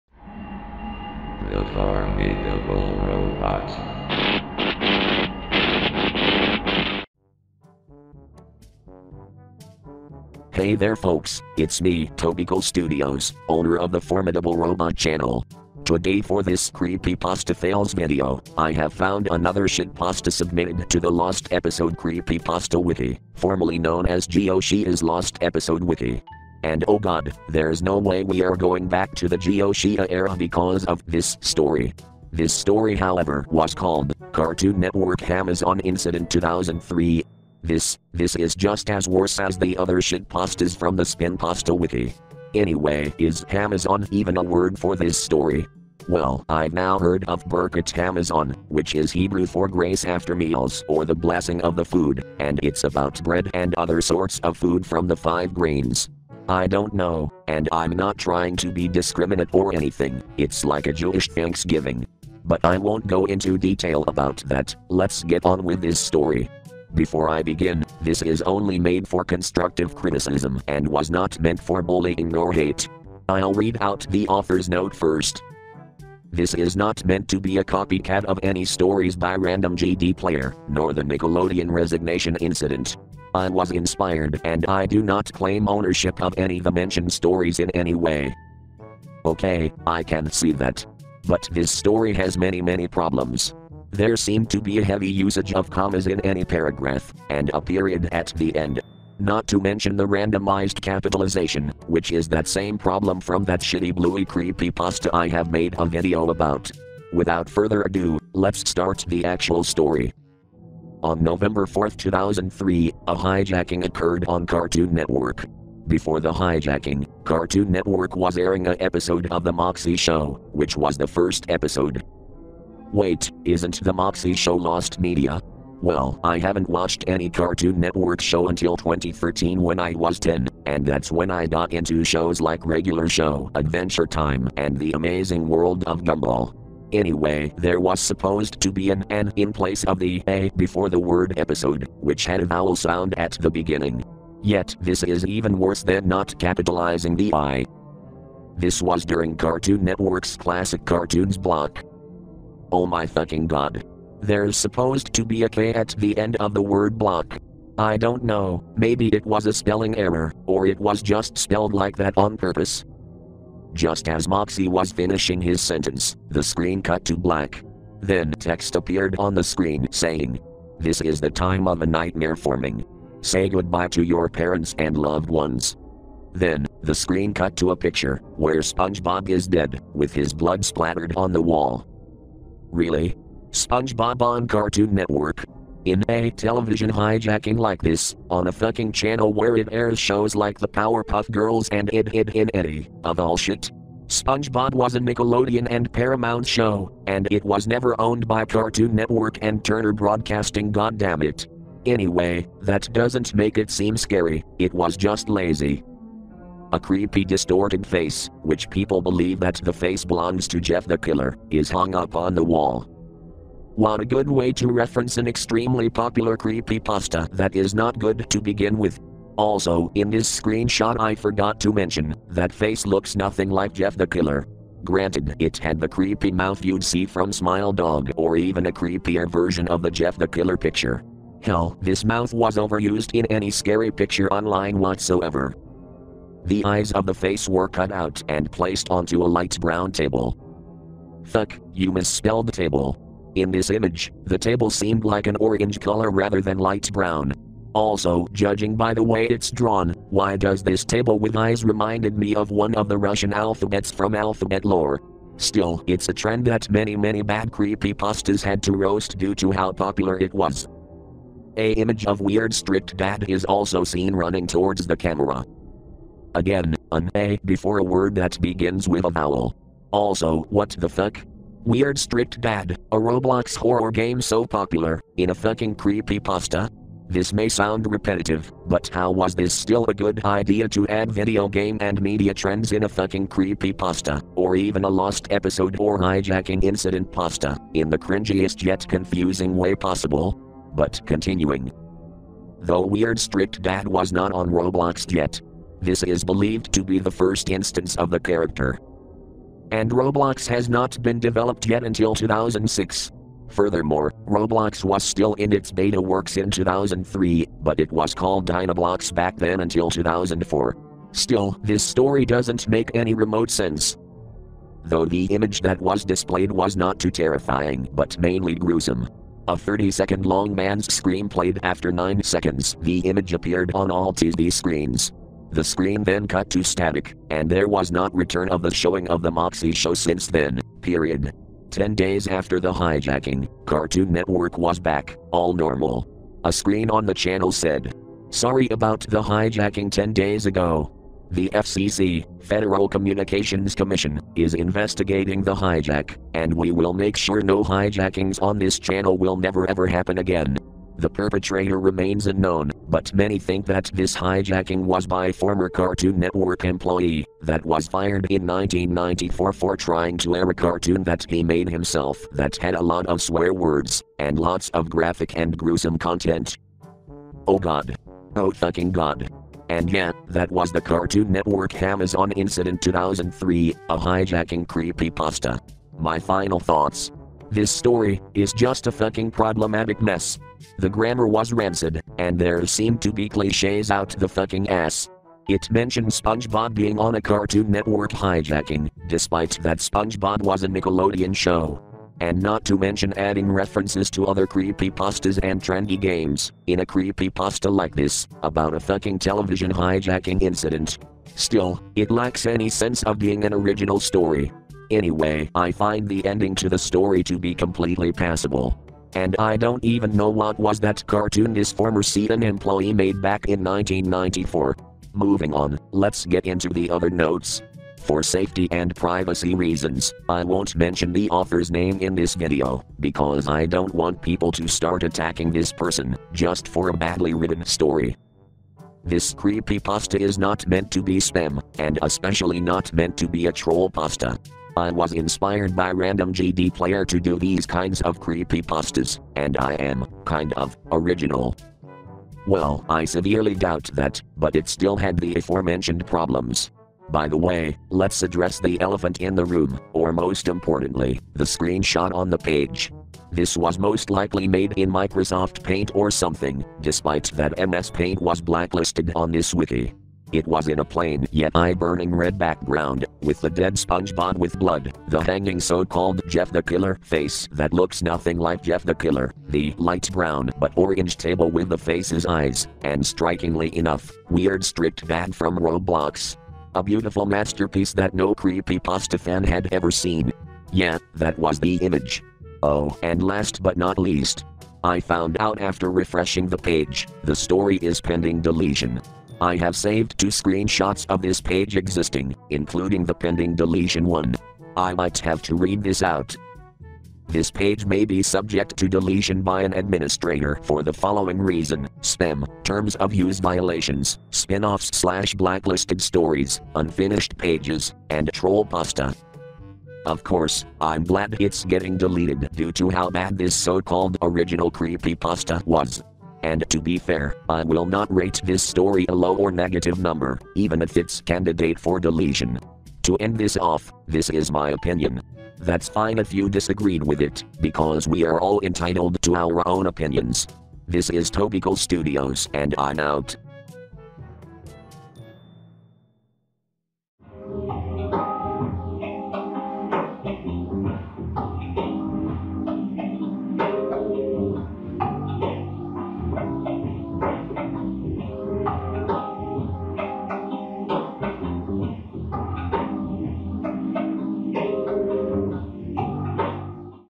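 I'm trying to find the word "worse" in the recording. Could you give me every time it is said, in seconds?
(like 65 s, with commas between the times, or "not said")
39 s, 145 s.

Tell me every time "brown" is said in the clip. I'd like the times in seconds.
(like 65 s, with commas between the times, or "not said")
239 s, 246 s, 470 s.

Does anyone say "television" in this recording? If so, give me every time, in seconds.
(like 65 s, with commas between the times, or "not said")
186 s, 399 s.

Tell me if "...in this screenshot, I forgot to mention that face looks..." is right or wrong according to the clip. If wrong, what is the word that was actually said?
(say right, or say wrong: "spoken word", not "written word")
right.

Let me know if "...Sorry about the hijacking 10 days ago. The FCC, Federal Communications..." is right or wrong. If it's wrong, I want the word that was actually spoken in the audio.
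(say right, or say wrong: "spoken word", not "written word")
right.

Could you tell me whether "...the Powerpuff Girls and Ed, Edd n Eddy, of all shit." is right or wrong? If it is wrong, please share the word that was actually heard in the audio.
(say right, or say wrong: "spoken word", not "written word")
right.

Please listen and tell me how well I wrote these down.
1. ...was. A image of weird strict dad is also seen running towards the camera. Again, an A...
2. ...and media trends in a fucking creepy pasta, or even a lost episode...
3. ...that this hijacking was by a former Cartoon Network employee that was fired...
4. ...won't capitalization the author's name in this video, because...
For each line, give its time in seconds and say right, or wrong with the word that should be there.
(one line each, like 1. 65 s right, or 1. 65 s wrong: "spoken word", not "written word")
1. 260 s right
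2. 281 s right
3. 353 s right
4. 420 s wrong: "mention", not "capitalization".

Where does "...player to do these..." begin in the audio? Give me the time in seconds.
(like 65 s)
436 s.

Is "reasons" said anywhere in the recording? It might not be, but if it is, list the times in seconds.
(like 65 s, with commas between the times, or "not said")
419 s, 501 s.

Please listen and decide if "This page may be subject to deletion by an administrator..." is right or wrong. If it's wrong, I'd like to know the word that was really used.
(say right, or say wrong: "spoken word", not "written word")
right.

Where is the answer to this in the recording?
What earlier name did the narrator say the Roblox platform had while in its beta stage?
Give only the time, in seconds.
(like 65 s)
308 s.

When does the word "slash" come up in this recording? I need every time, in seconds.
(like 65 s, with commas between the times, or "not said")
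504 s.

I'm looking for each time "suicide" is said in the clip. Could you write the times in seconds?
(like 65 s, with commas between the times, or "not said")
not said.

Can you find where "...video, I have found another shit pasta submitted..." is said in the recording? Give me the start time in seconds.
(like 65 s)
17 s.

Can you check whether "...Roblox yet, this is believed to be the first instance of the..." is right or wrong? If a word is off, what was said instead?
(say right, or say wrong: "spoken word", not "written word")
right.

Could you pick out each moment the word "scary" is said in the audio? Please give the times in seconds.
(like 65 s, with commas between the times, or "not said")
203 s, 233 s.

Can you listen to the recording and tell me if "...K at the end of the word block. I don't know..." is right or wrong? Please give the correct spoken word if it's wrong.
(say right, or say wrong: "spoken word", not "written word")
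right.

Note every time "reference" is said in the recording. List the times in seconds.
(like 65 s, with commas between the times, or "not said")
214 s, 393 s.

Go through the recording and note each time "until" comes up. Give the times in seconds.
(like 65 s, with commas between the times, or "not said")
128 s, 301 s, 309 s.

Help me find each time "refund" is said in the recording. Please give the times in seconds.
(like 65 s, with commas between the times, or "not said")
not said.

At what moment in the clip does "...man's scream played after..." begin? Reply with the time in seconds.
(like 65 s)
320 s.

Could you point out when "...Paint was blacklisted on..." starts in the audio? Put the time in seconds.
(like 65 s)
457 s.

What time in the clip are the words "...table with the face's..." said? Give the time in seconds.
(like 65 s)
471 s.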